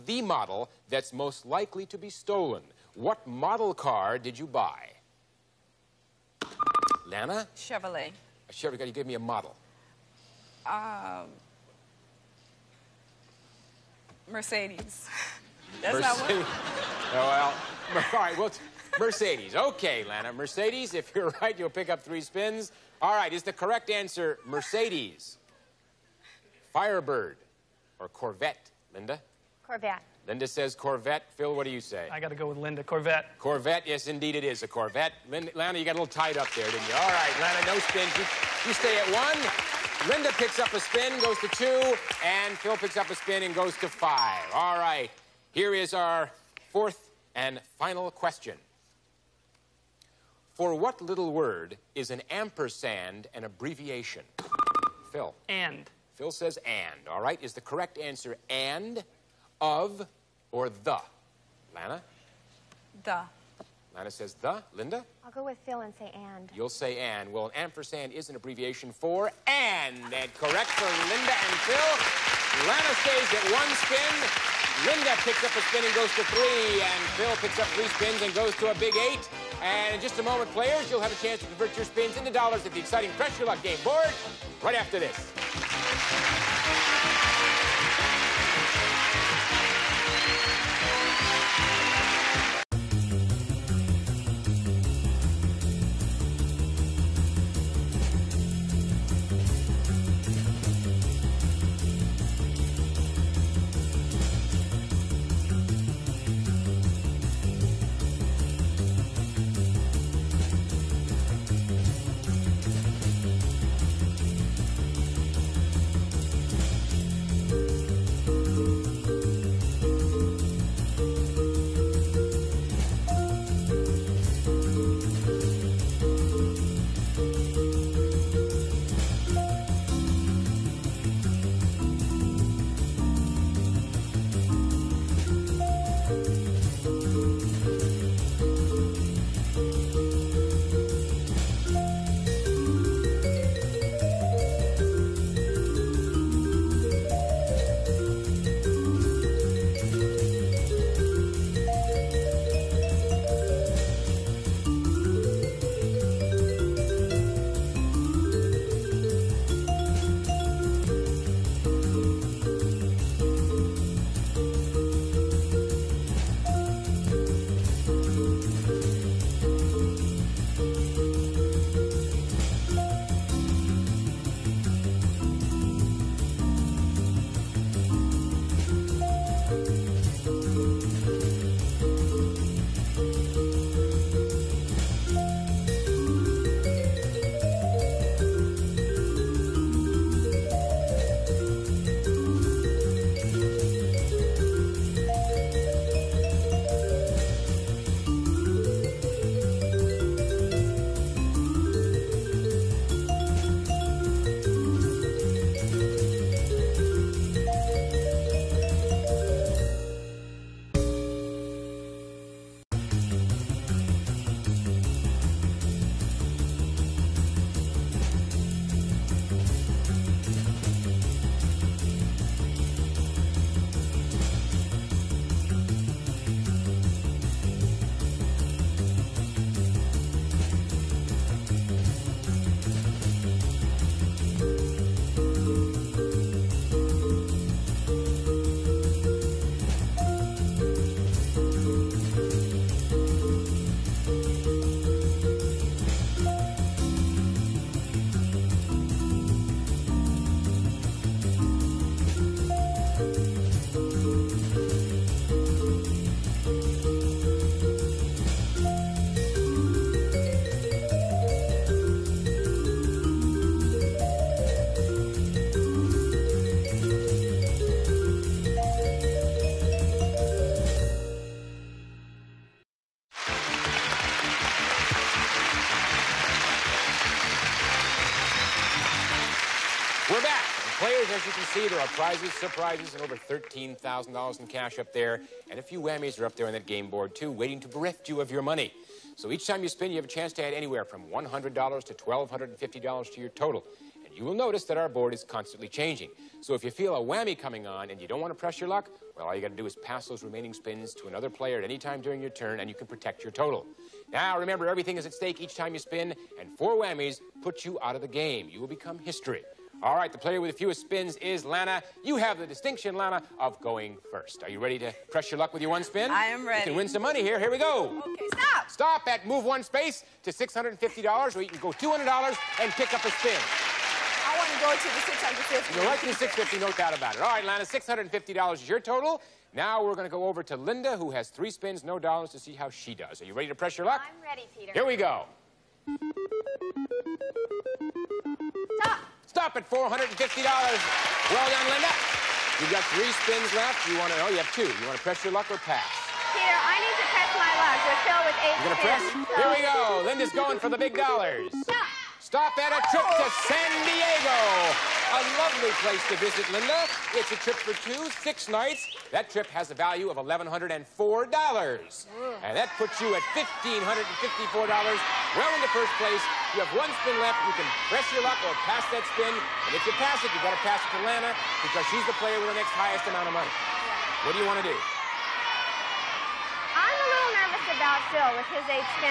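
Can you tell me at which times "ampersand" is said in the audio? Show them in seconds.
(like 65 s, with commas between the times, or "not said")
52 s, 67 s.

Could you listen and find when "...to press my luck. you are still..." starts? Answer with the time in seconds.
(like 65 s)
346 s.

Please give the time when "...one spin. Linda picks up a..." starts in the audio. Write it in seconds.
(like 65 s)
73 s.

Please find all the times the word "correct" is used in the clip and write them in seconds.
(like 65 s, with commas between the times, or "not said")
23 s, 57 s, 70 s.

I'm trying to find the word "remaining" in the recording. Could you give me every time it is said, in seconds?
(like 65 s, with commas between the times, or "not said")
300 s.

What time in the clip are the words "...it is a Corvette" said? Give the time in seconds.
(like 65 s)
34 s.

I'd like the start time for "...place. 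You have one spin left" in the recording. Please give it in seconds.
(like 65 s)
365 s.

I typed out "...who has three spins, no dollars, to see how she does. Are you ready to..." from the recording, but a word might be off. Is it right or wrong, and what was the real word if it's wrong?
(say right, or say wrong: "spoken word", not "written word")
right.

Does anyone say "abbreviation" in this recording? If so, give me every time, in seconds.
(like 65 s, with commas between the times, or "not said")
53 s, 68 s.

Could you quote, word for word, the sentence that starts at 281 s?
prizes, surprises, and over $13,000 in cash up there.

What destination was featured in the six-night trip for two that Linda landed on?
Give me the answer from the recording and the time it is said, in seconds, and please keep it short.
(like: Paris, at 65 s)
San Diego, at 353 s.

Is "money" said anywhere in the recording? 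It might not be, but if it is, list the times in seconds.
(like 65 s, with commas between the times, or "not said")
288 s, 317 s, 373 s.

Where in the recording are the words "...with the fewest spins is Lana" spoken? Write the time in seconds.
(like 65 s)
310 s.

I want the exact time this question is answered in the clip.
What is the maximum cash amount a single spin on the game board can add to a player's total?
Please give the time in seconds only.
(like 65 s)
291 s.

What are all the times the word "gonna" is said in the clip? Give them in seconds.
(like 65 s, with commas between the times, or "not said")
348 s.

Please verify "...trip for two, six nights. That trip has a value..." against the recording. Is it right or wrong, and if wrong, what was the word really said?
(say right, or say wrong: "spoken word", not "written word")
right.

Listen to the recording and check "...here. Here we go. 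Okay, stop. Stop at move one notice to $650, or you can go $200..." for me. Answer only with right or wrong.
wrong.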